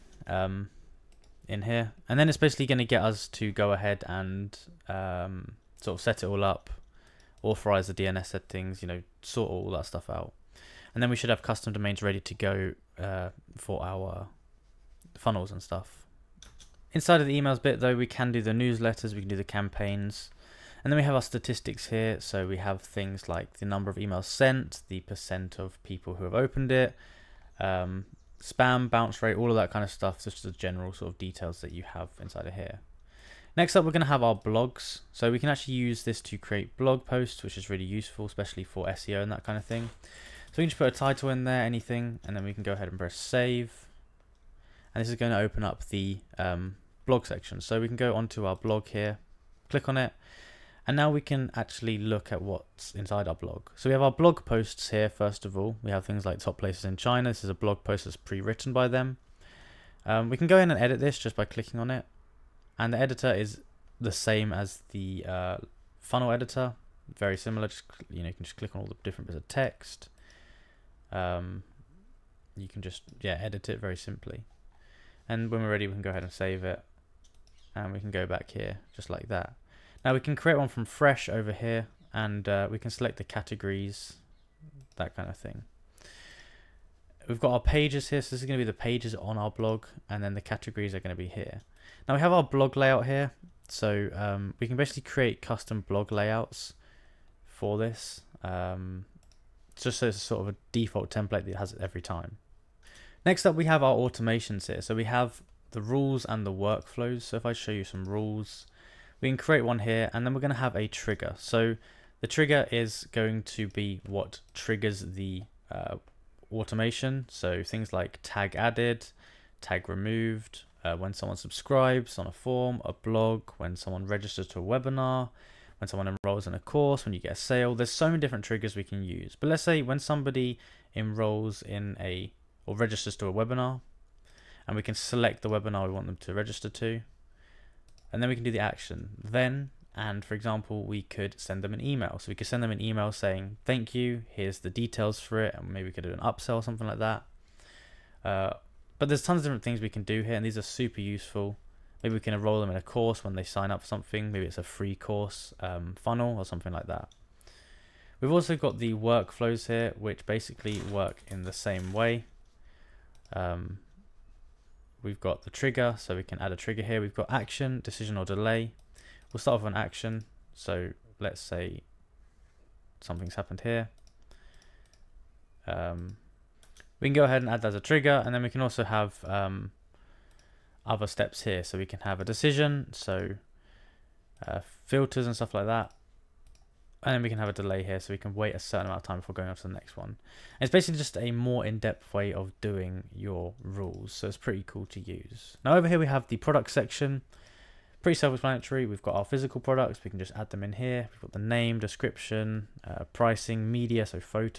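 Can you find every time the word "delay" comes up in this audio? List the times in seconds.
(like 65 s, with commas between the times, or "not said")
168 s, 187 s.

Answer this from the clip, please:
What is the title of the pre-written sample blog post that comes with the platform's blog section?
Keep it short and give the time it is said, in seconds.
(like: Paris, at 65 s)
Top places in China, at 56 s.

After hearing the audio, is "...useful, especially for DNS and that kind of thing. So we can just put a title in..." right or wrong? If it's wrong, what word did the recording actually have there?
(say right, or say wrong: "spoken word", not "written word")
wrong: "SEO", not "DNS".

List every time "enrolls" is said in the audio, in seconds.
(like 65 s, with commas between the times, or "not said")
126 s, 130 s, 152 s.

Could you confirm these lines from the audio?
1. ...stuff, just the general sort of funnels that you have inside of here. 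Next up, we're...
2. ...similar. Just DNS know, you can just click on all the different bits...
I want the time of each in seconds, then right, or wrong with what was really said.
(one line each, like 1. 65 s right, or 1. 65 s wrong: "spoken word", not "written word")
1. 29 s wrong: "details", not "funnels"
2. 67 s wrong: "You", not "DNS".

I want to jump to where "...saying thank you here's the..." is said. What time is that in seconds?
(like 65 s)
143 s.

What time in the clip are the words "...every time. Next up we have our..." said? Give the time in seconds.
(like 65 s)
101 s.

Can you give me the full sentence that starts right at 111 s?
So the trigger is going to be what triggers the uh, automation.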